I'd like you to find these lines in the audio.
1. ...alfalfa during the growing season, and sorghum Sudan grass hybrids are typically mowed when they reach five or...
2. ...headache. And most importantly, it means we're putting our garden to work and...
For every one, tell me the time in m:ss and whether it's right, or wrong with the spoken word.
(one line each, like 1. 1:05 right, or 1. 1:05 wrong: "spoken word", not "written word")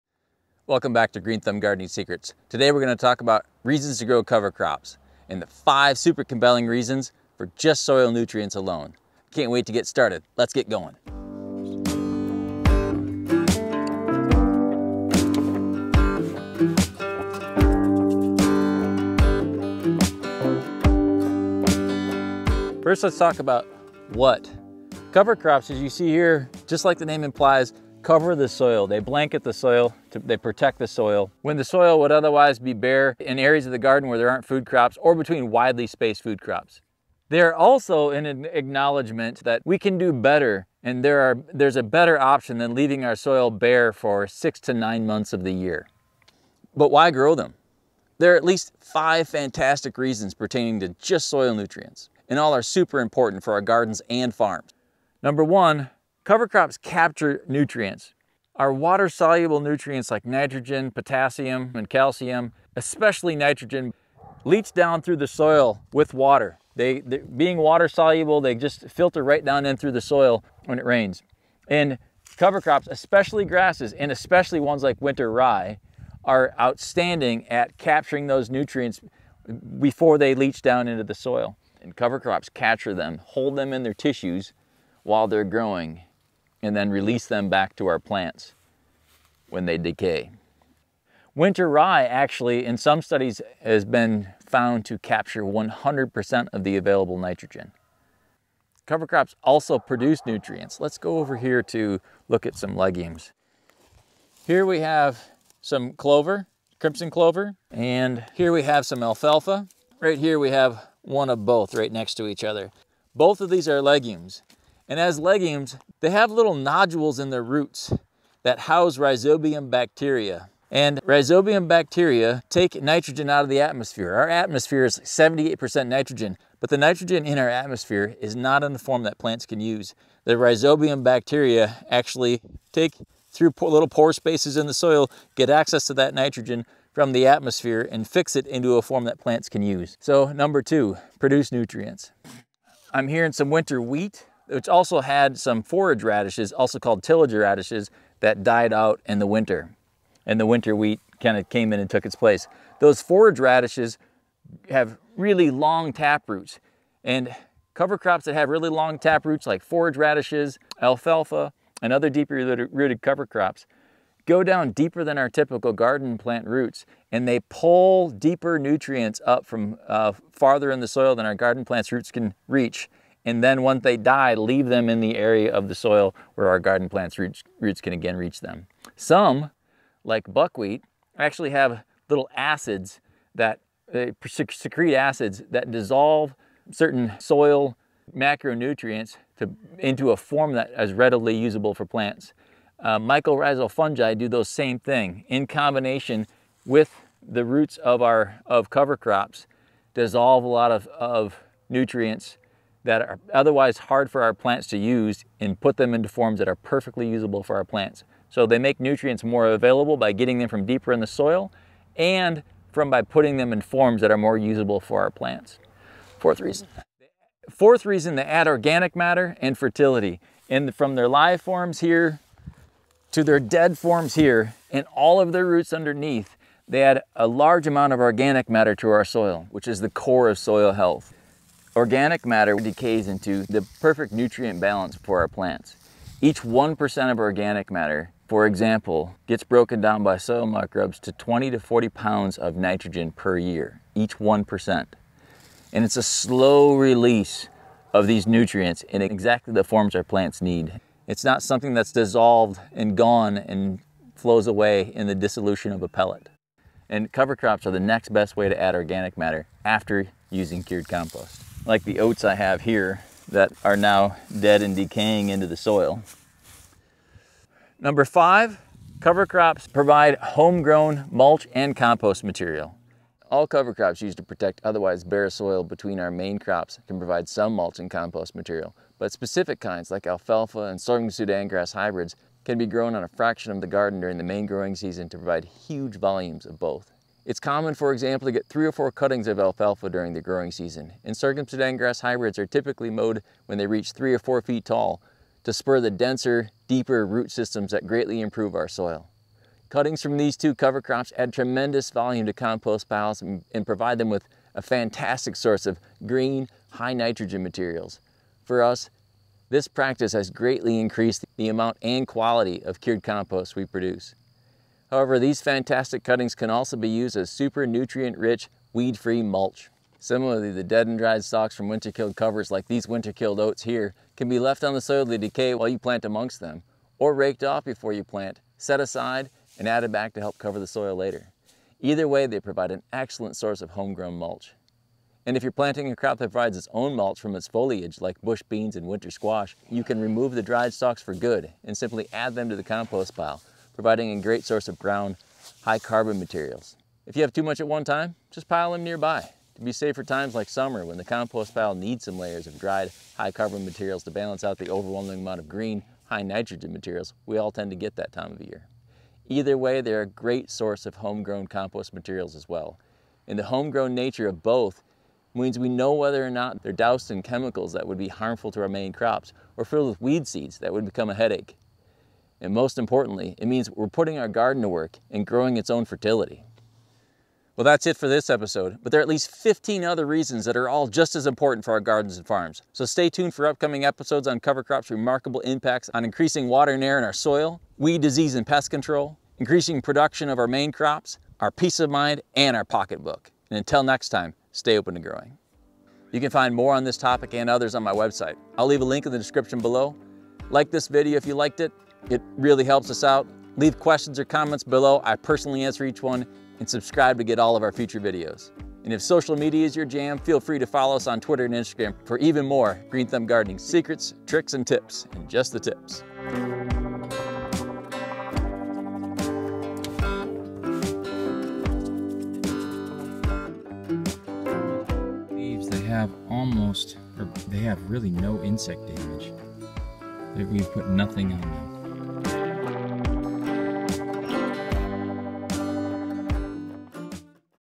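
1. 4:49 wrong: "three", not "five"
2. 6:11 right.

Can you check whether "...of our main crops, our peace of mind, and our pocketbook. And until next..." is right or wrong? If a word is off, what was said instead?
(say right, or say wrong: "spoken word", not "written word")
right.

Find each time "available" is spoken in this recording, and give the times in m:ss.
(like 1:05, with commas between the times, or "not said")
1:36, 3:29.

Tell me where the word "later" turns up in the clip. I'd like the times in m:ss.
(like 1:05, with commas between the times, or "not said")
5:30.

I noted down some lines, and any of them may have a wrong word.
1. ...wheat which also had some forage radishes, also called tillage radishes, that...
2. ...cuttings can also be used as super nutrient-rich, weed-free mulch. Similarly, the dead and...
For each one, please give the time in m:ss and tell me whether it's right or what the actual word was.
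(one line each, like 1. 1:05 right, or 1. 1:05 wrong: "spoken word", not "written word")
1. 2:23 right
2. 5:16 right.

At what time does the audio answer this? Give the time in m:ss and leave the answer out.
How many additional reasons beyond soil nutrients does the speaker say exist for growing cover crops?
6:19.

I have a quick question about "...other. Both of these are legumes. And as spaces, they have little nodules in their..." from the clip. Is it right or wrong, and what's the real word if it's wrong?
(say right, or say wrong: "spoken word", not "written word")
wrong: "legumes", not "spaces".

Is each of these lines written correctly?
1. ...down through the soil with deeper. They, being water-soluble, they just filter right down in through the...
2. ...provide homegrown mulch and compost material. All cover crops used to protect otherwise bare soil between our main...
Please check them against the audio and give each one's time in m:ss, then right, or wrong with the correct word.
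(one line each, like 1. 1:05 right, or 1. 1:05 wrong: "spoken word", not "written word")
1. 1:04 wrong: "water", not "deeper"
2. 4:29 right.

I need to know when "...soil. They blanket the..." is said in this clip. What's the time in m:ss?
0:28.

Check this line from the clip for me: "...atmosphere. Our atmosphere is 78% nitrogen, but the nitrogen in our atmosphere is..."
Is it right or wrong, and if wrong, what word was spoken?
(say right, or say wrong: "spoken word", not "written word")
right.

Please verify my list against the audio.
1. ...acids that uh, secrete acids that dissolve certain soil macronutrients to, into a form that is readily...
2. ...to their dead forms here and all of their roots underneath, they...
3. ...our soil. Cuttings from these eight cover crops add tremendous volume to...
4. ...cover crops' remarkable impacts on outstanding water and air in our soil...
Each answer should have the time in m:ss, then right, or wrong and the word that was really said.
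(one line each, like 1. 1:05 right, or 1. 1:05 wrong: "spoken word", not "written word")
1. 3:02 right
2. 3:43 right
3. 4:58 wrong: "two", not "eight"
4. 6:24 wrong: "increasing", not "outstanding".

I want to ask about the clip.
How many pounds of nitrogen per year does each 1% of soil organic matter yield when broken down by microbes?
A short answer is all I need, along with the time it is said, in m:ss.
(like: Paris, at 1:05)
20 to 40 pounds, at 4:01.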